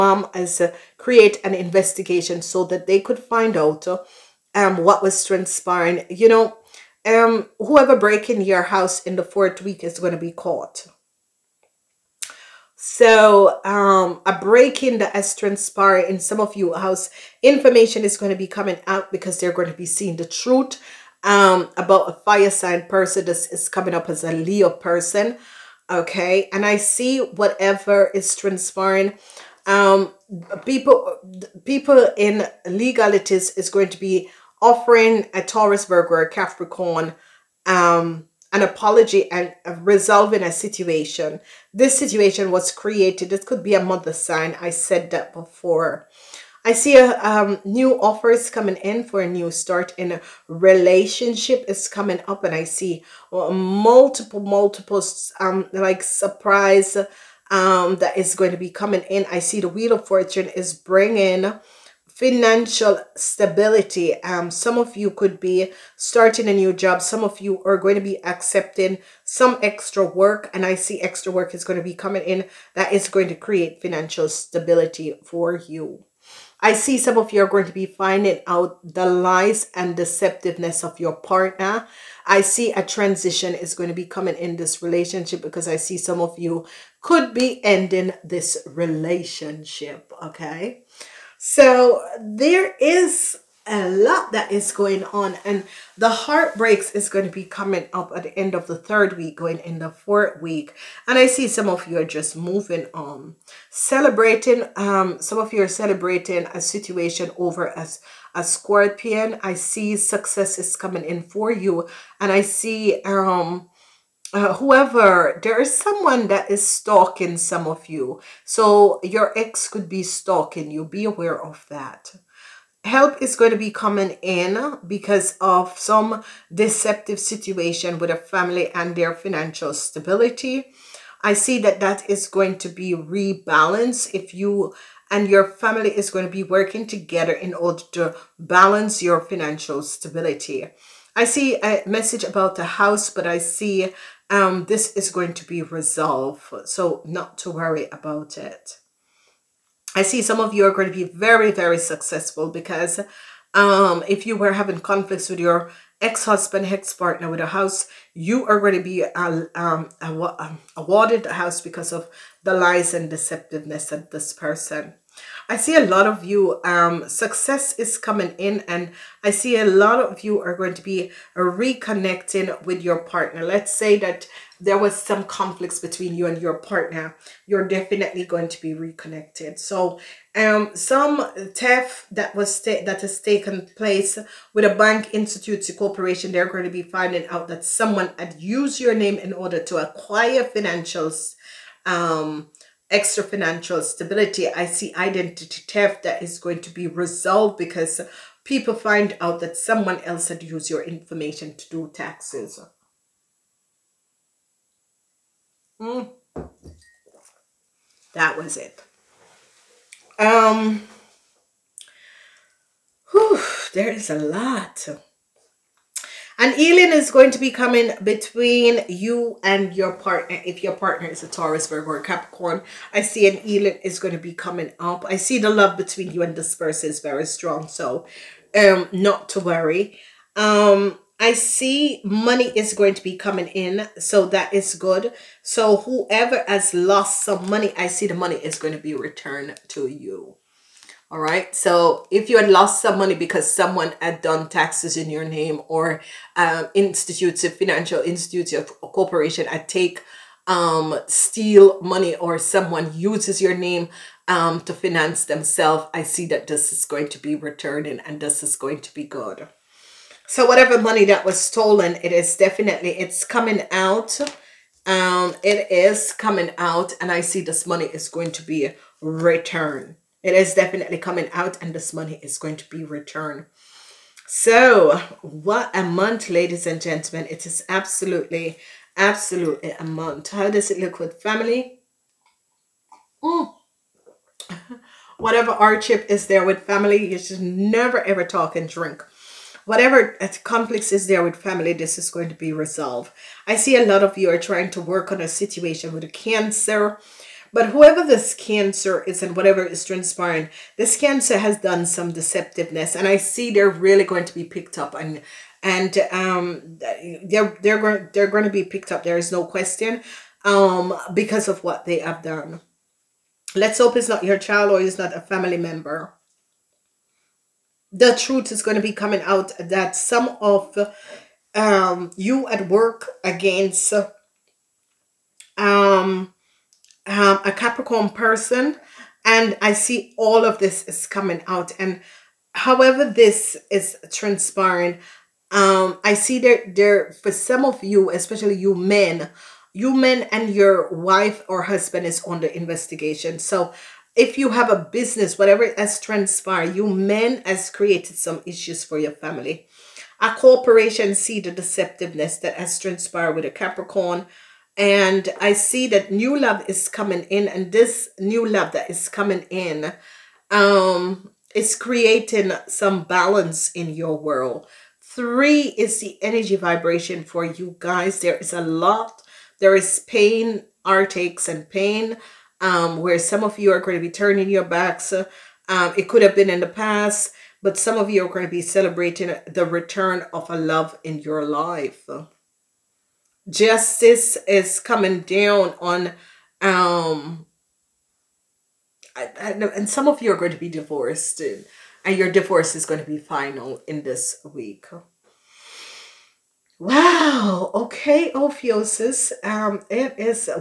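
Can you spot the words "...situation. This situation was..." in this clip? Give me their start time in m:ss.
0:40.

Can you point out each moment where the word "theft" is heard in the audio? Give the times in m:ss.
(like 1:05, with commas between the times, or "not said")
3:01, 3:15.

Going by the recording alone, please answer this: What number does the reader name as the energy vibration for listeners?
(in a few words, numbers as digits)
3.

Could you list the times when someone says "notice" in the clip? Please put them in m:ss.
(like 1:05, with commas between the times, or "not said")
not said.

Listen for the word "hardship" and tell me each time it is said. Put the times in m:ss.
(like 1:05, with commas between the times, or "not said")
4:45.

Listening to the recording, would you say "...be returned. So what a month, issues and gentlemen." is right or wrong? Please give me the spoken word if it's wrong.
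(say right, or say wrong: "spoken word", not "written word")
wrong: "ladies", not "issues".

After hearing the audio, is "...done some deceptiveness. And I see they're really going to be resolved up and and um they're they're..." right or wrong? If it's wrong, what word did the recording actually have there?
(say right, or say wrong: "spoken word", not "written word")
wrong: "picked", not "resolved".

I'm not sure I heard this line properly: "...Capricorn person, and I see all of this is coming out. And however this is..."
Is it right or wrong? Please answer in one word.
right.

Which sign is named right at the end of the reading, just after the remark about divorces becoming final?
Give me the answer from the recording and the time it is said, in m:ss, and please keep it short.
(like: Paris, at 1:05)
Ophiuchus, at 6:38.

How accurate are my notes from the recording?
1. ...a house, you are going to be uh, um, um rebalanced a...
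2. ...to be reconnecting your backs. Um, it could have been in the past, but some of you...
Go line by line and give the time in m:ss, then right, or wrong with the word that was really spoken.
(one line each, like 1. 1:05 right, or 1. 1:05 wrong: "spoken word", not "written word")
1. 2:37 wrong: "awarded", not "rebalanced"
2. 6:13 wrong: "turning", not "reconnecting".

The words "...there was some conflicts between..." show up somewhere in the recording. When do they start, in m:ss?
2:54.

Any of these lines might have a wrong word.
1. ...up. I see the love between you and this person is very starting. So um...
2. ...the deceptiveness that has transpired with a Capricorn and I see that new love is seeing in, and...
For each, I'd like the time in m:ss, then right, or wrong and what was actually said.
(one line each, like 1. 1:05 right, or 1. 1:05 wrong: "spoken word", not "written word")
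1. 3:44 wrong: "strong", not "starting"
2. 5:51 wrong: "coming", not "seeing".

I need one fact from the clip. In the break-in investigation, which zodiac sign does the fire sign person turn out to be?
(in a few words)
Leo.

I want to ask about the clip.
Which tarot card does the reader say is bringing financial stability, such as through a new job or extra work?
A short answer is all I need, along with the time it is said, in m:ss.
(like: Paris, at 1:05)
Wheel of Fortune, at 0:59.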